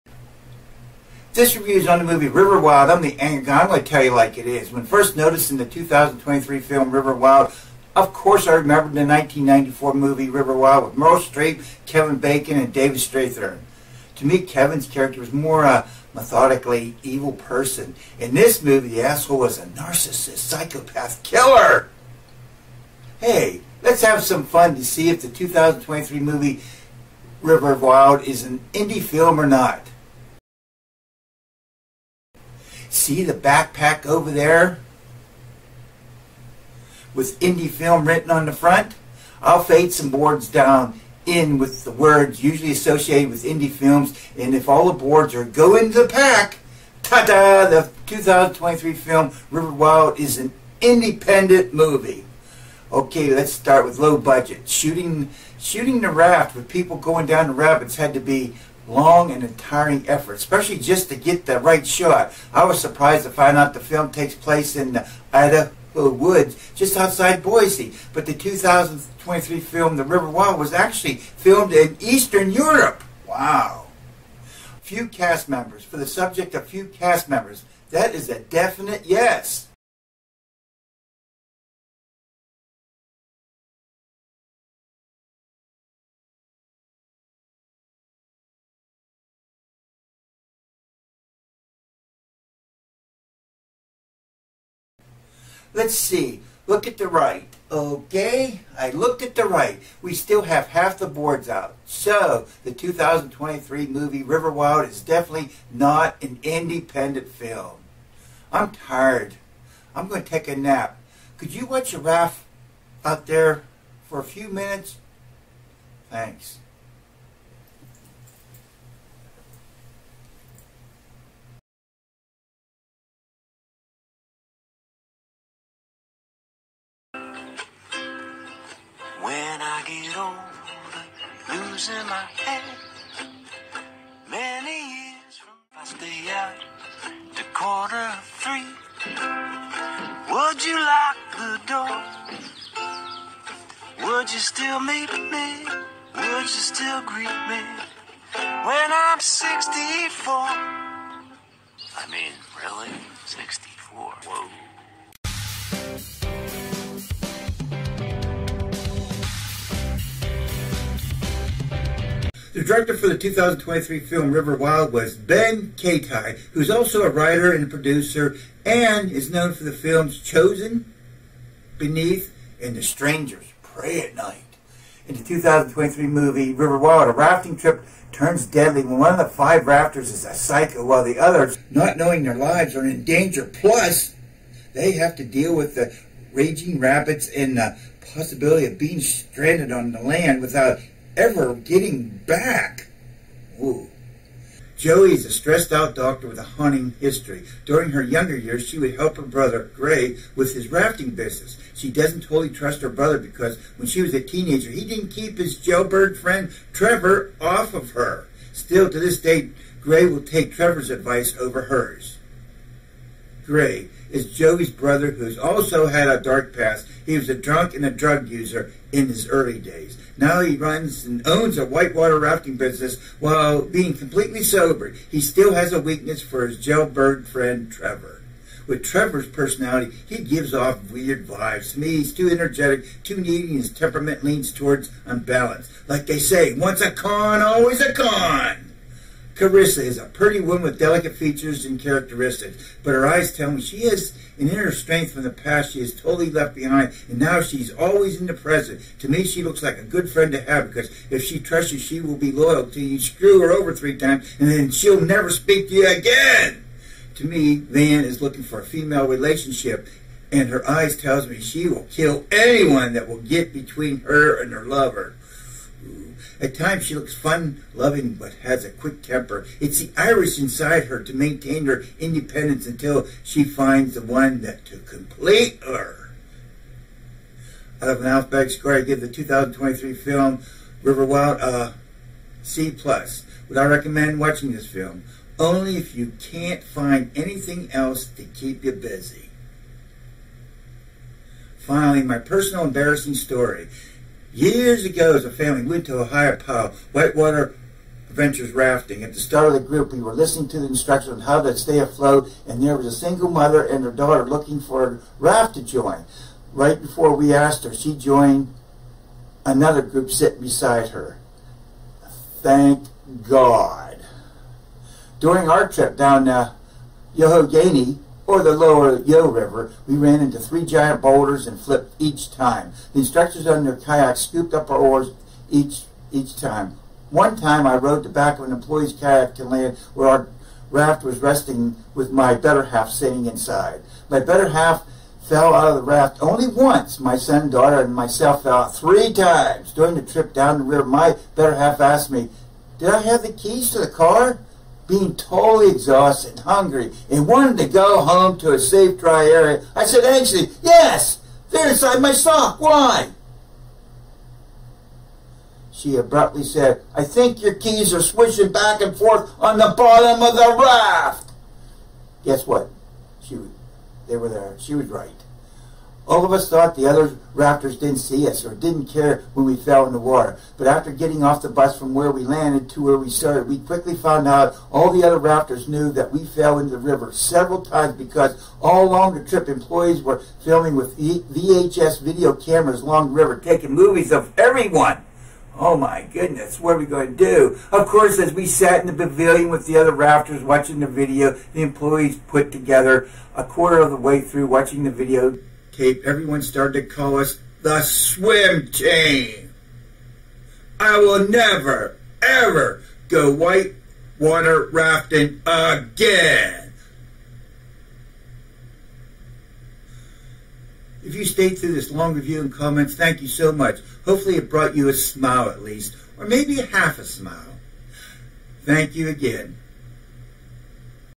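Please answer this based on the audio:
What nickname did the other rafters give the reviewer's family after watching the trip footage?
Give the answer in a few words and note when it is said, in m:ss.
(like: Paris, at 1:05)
the swim team, at 6:37.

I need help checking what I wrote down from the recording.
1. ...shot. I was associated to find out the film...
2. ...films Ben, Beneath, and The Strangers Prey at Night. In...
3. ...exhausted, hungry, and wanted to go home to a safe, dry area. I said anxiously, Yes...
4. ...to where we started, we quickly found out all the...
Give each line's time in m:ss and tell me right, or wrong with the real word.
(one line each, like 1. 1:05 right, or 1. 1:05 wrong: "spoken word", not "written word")
1. 1:01 wrong: "surprised", not "associated"
2. 2:49 wrong: "Chosen", not "Ben"
3. 5:45 right
4. 6:12 right.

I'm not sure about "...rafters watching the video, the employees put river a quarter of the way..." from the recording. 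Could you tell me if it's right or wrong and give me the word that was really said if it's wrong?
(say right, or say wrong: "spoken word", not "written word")
wrong: "together", not "river".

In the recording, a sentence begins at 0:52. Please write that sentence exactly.
Okay, let's start with low budget.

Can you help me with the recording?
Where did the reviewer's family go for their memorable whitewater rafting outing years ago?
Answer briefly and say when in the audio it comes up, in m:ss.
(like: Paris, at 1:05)
Ohiopyle, at 4:56.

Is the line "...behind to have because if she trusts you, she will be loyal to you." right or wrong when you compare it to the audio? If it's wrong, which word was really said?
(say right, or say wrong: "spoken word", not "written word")
wrong: "friend", not "behind".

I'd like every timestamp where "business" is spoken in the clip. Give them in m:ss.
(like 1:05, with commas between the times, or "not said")
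3:21, 3:42.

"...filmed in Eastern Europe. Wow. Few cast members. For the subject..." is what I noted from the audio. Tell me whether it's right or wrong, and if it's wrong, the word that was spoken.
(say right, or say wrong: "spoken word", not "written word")
right.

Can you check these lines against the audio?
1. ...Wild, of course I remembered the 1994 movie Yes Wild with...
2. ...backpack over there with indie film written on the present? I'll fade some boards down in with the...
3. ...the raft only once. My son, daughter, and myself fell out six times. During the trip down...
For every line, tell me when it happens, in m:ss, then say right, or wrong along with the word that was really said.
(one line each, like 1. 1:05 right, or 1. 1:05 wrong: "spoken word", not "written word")
1. 0:07 wrong: "River", not "Yes"
2. 0:33 wrong: "front", not "present"
3. 5:35 wrong: "three", not "six".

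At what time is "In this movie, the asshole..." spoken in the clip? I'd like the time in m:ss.
0:18.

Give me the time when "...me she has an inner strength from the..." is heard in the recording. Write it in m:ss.
4:03.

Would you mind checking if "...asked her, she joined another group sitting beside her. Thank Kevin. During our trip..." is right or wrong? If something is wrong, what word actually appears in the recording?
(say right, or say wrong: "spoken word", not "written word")
wrong: "God", not "Kevin".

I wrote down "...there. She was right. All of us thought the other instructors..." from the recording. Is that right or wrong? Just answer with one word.
wrong.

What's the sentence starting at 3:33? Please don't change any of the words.
Gray is Joey's brother who's also had a dark past.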